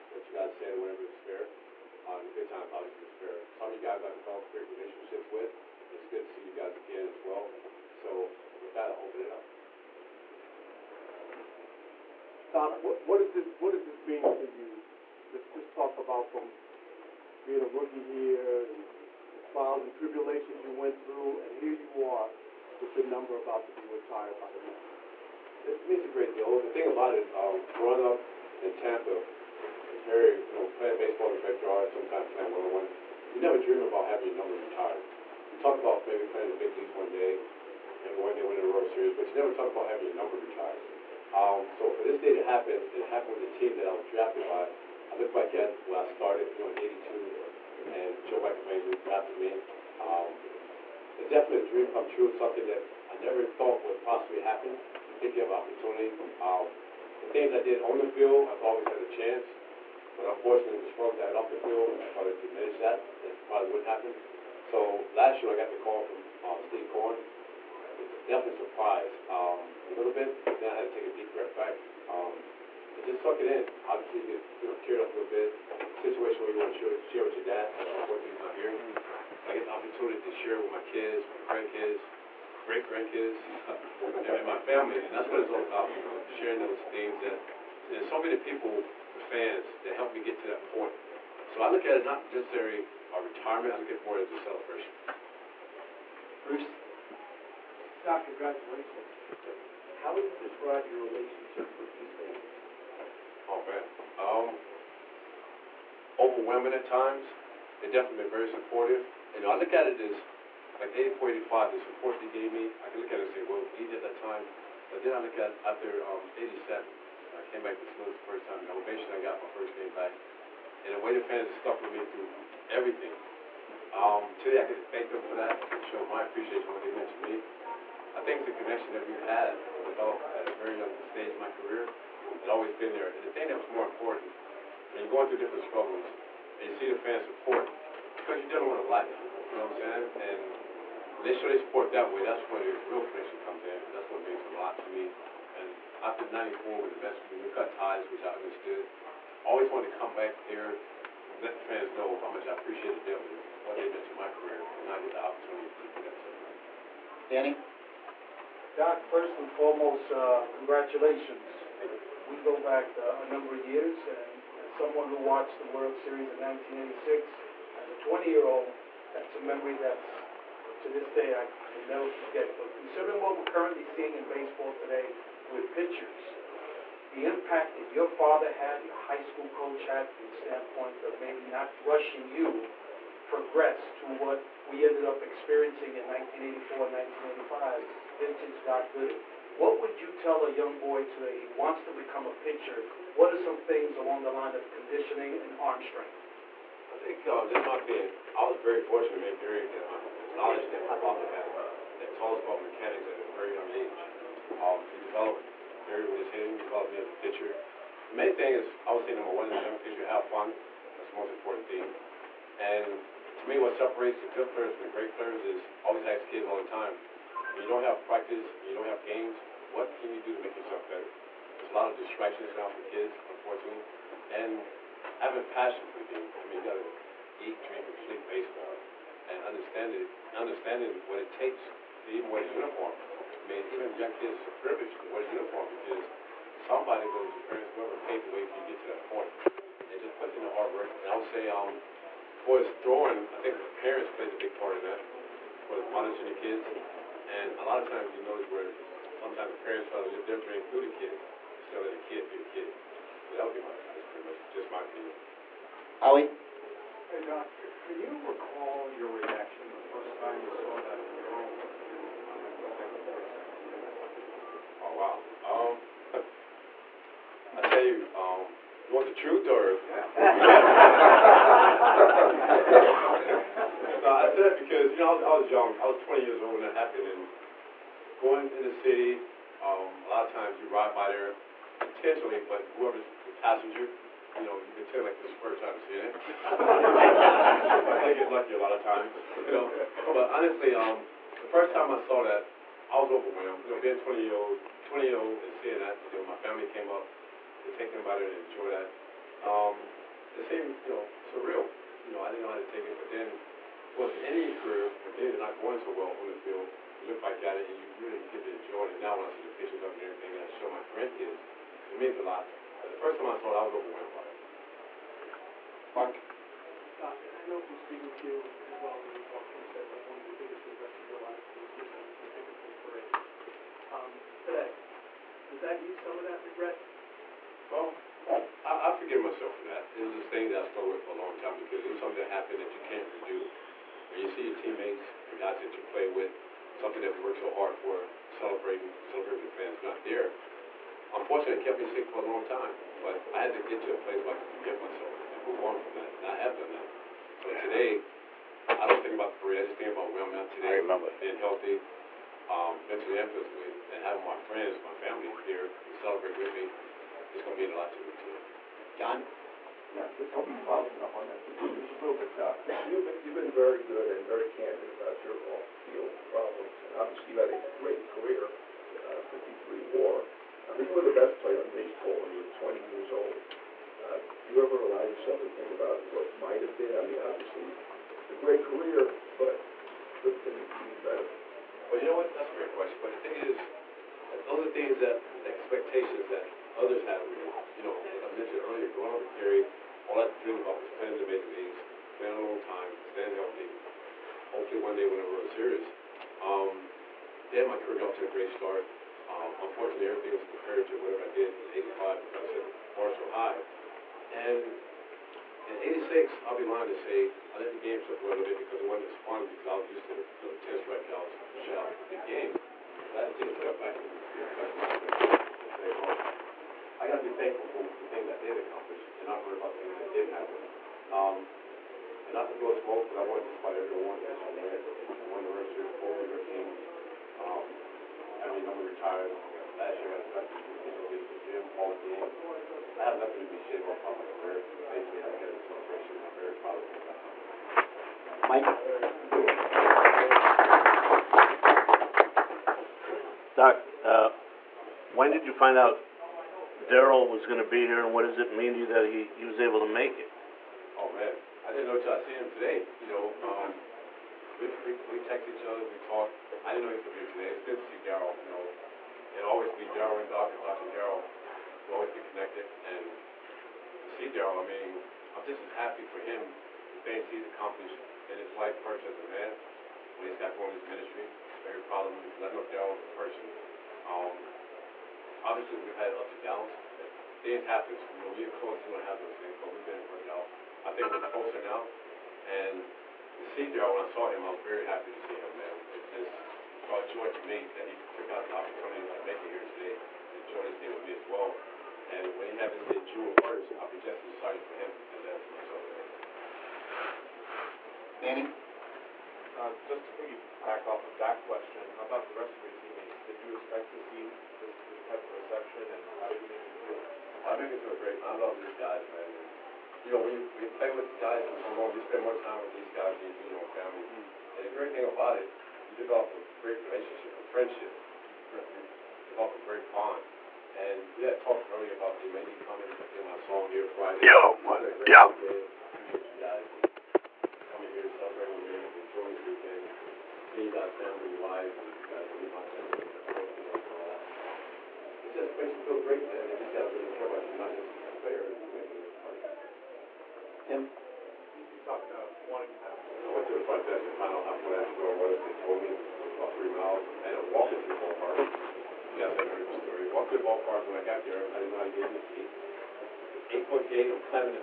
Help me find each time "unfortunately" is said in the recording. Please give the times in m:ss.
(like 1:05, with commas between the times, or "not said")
1:00, 1:17, 3:43, 5:41, 6:39.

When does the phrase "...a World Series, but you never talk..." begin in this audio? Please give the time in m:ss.
0:38.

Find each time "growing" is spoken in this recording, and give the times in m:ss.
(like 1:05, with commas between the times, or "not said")
0:27, 6:28.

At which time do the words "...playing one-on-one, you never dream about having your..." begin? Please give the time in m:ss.
0:32.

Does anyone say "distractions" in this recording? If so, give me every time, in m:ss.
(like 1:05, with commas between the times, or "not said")
3:41.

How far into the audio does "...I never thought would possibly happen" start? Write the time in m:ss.
0:53.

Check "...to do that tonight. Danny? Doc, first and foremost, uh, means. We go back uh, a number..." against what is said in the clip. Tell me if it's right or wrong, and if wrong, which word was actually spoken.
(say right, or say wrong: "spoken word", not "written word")
wrong: "congratulations", not "means".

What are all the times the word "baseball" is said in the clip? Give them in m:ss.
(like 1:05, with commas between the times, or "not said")
0:30, 2:54, 3:48, 6:11.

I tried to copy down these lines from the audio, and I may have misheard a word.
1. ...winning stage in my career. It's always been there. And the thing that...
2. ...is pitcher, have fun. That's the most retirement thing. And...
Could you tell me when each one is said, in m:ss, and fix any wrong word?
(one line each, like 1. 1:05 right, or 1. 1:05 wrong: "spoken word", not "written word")
1. 2:10 wrong: "young", not "winning"
2. 3:29 wrong: "important", not "retirement".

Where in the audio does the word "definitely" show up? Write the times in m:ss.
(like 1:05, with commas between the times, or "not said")
0:51, 1:08, 1:47.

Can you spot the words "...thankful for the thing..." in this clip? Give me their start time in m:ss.
6:57.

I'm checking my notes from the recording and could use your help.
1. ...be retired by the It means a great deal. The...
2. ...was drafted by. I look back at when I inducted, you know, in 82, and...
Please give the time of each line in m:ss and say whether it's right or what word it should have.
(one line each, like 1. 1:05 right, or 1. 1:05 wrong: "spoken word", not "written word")
1. 0:23 right
2. 0:43 wrong: "started", not "inducted".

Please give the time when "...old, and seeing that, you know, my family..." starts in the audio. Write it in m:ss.
4:55.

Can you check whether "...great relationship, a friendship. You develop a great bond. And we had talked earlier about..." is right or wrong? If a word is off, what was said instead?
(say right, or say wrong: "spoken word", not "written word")
right.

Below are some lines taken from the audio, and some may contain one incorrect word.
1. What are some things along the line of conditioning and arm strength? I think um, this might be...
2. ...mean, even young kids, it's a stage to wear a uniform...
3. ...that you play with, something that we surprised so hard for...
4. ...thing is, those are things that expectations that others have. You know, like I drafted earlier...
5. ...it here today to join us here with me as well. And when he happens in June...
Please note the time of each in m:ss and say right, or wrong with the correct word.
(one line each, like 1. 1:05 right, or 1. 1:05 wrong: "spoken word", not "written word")
1. 3:13 right
2. 3:53 wrong: "privilege", not "stage"
3. 5:35 wrong: "worked", not "surprised"
4. 6:23 wrong: "mentioned", not "drafted"
5. 8:09 right.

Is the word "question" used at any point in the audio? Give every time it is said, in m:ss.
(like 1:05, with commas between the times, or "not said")
6:22, 8:21.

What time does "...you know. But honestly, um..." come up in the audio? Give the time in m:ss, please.
4:49.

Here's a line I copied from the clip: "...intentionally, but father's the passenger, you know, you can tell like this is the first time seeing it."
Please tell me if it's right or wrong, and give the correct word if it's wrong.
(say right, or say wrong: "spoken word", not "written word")
wrong: "whoever", not "father".